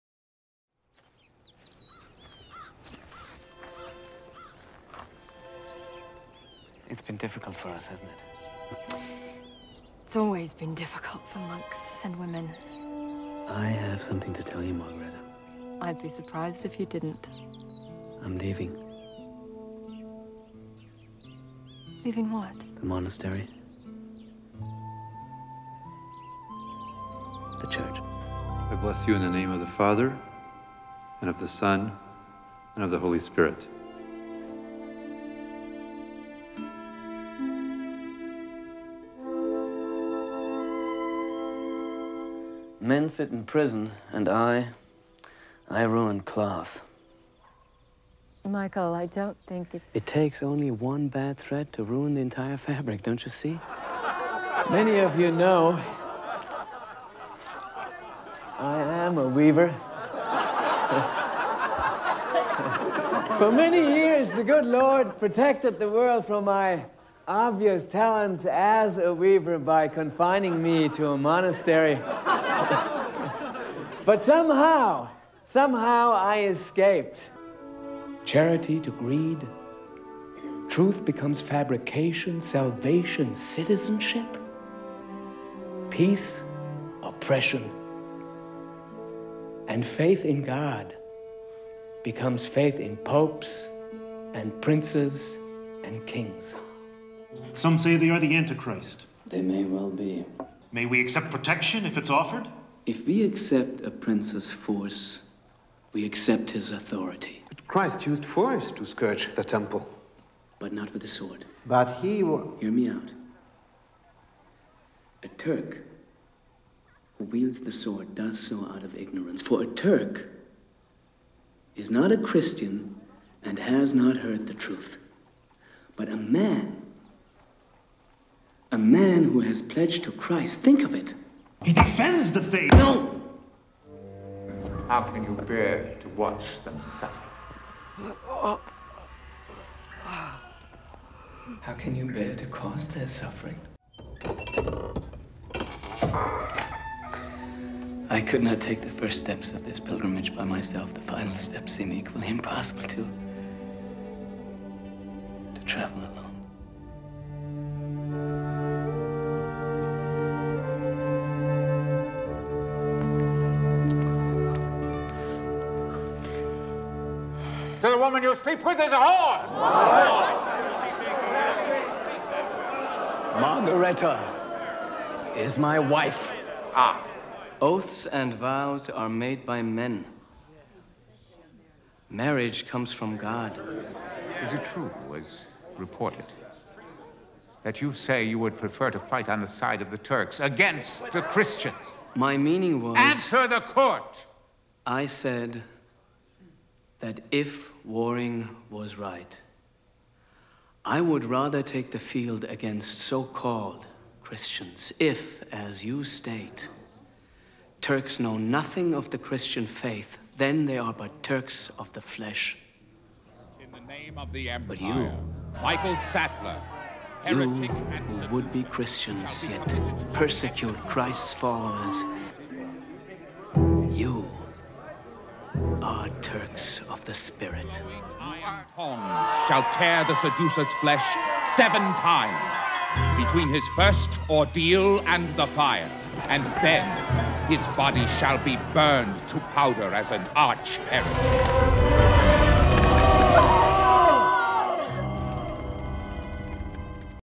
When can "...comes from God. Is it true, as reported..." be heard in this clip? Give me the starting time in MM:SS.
03:02.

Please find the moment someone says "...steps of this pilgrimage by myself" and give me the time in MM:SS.
02:29.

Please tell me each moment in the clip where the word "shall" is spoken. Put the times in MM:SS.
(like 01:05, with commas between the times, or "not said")
03:49, 03:58.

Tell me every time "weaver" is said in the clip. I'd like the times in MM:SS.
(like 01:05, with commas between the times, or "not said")
00:59, 01:09.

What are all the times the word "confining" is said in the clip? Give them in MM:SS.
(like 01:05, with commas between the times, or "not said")
01:09.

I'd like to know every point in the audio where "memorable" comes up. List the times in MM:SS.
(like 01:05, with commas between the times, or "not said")
not said.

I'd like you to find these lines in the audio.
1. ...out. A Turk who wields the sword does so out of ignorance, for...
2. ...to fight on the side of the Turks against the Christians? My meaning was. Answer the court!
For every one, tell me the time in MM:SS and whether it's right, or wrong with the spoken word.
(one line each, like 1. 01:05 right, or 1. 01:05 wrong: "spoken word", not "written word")
1. 01:52 right
2. 03:08 right.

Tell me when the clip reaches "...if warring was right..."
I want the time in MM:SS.
03:17.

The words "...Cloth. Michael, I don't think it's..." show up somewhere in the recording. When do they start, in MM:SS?
00:46.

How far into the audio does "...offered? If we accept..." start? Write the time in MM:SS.
01:42.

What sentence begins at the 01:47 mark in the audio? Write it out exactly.
But Christ used force to scourge the temple.